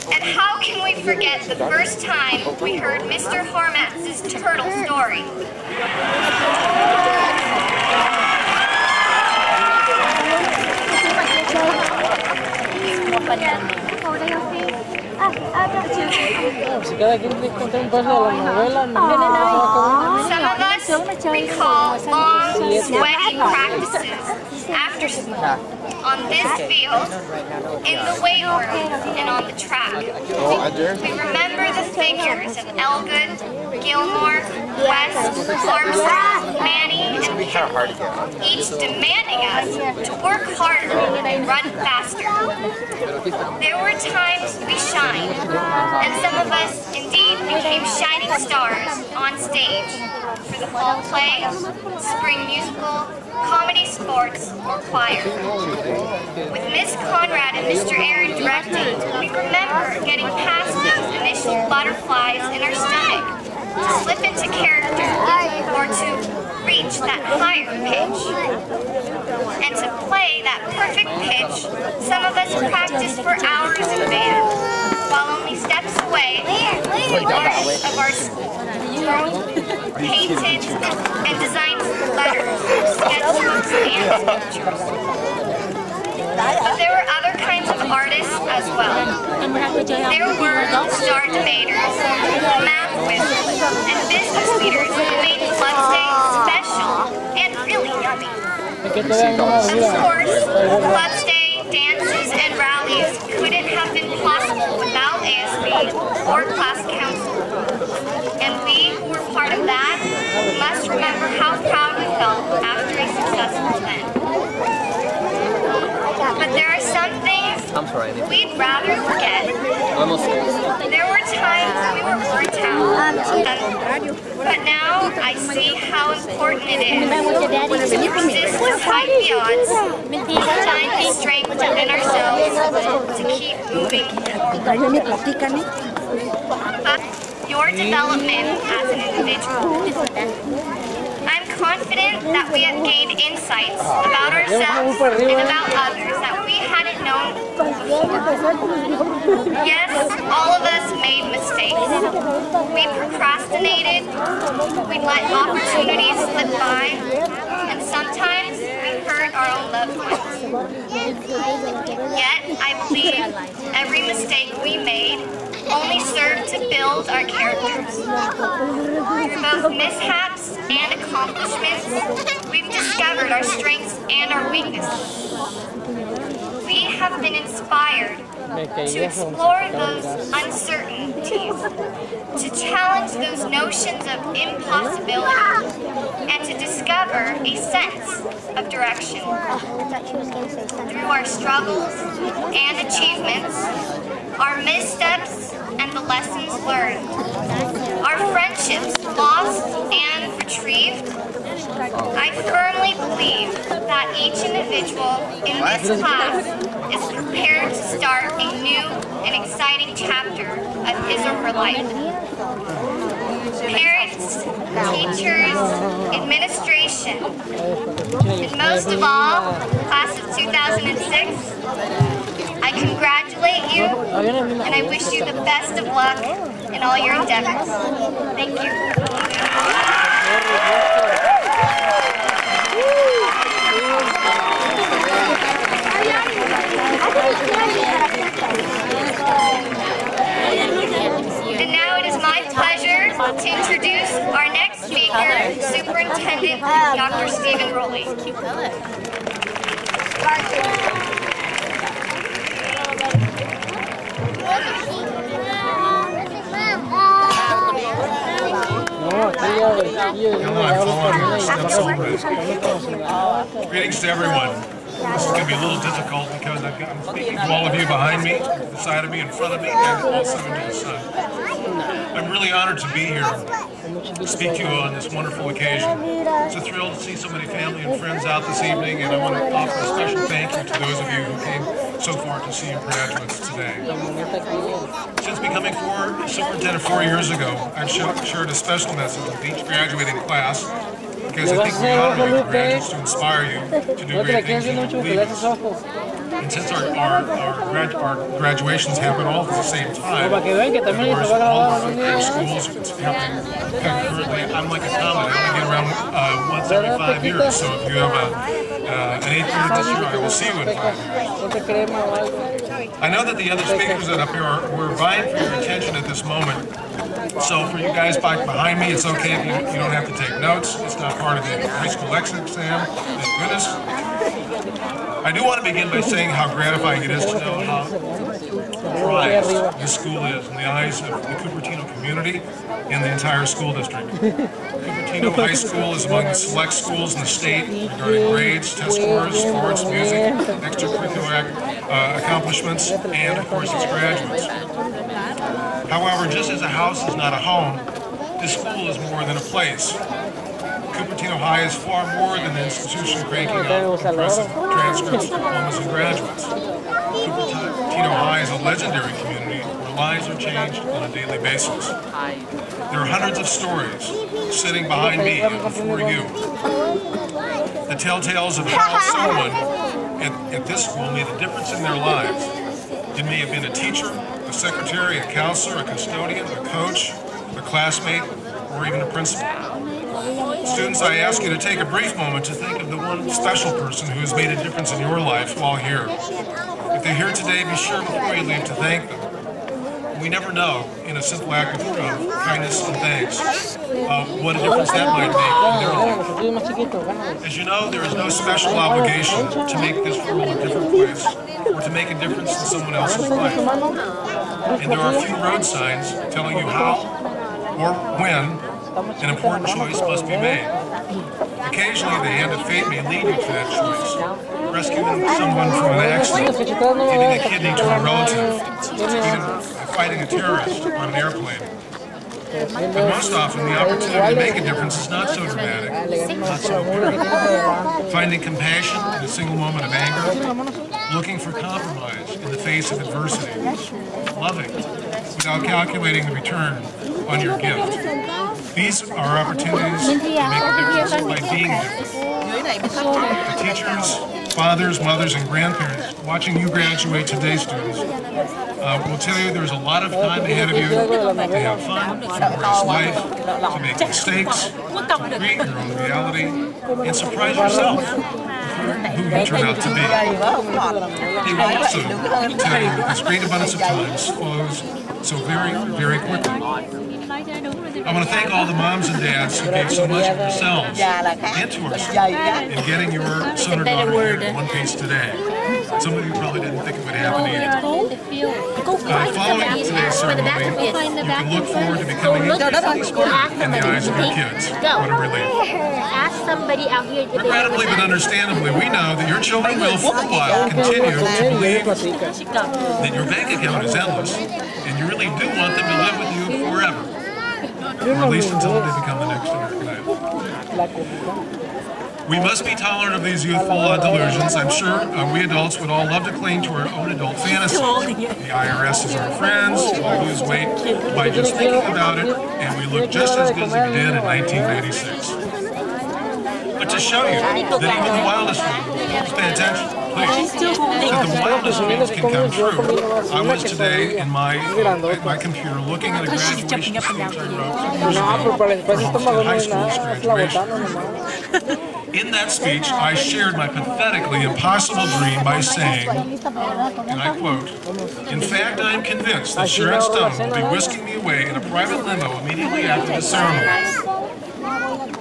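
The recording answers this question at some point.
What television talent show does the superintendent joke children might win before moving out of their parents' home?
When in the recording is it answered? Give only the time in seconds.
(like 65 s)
499 s.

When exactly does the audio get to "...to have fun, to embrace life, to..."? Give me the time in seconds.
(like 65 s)
450 s.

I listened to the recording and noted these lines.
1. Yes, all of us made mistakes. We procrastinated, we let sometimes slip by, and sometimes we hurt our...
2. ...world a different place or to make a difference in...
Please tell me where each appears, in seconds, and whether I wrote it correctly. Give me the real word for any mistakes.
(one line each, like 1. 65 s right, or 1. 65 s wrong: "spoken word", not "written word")
1. 149 s wrong: "opportunities", not "sometimes"
2. 400 s right.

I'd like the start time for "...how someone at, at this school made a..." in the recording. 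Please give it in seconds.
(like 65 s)
368 s.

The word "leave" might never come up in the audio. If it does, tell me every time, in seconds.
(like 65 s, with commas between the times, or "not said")
388 s.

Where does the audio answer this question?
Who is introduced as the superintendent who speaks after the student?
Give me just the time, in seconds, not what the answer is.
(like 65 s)
246 s.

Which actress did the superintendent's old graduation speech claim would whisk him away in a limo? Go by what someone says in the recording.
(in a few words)
Sharon Stone.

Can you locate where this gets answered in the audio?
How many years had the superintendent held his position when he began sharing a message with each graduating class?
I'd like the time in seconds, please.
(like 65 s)
286 s.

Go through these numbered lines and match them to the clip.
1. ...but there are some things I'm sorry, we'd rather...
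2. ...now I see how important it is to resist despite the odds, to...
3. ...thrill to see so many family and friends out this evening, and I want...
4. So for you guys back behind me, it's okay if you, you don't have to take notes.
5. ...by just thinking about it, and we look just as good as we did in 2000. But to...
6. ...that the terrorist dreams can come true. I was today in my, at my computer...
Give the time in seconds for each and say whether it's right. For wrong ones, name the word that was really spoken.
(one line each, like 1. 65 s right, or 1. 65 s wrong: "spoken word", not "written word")
1. 116 s right
2. 124 s right
3. 276 s right
4. 317 s right
5. 511 s wrong: "1996", not "2000"
6. 521 s wrong: "wildest", not "terrorist".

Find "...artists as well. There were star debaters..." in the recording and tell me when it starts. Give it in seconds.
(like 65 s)
87 s.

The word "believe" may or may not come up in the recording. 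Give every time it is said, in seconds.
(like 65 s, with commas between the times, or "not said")
162 s, 202 s, 294 s, 491 s.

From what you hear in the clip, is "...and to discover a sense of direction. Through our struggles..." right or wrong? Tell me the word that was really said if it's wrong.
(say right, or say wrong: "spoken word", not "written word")
right.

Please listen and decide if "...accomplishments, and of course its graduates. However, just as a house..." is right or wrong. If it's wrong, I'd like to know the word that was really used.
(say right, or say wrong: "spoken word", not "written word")
right.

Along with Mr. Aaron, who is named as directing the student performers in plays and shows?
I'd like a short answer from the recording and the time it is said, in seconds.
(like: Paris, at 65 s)
Miss Conrad, at 56 s.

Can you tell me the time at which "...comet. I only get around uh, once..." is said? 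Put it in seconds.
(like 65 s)
304 s.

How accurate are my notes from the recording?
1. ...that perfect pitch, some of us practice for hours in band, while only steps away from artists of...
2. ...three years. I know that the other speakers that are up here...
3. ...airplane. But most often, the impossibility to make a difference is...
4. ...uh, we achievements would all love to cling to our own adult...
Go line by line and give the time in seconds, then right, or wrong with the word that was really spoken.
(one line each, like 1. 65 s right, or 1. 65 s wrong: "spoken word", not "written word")
1. 70 s right
2. 310 s wrong: "five", not "three"
3. 421 s wrong: "opportunity", not "impossibility"
4. 504 s wrong: "adults", not "achievements".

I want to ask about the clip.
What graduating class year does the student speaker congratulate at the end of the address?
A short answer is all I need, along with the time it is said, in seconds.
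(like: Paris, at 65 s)
2006, at 220 s.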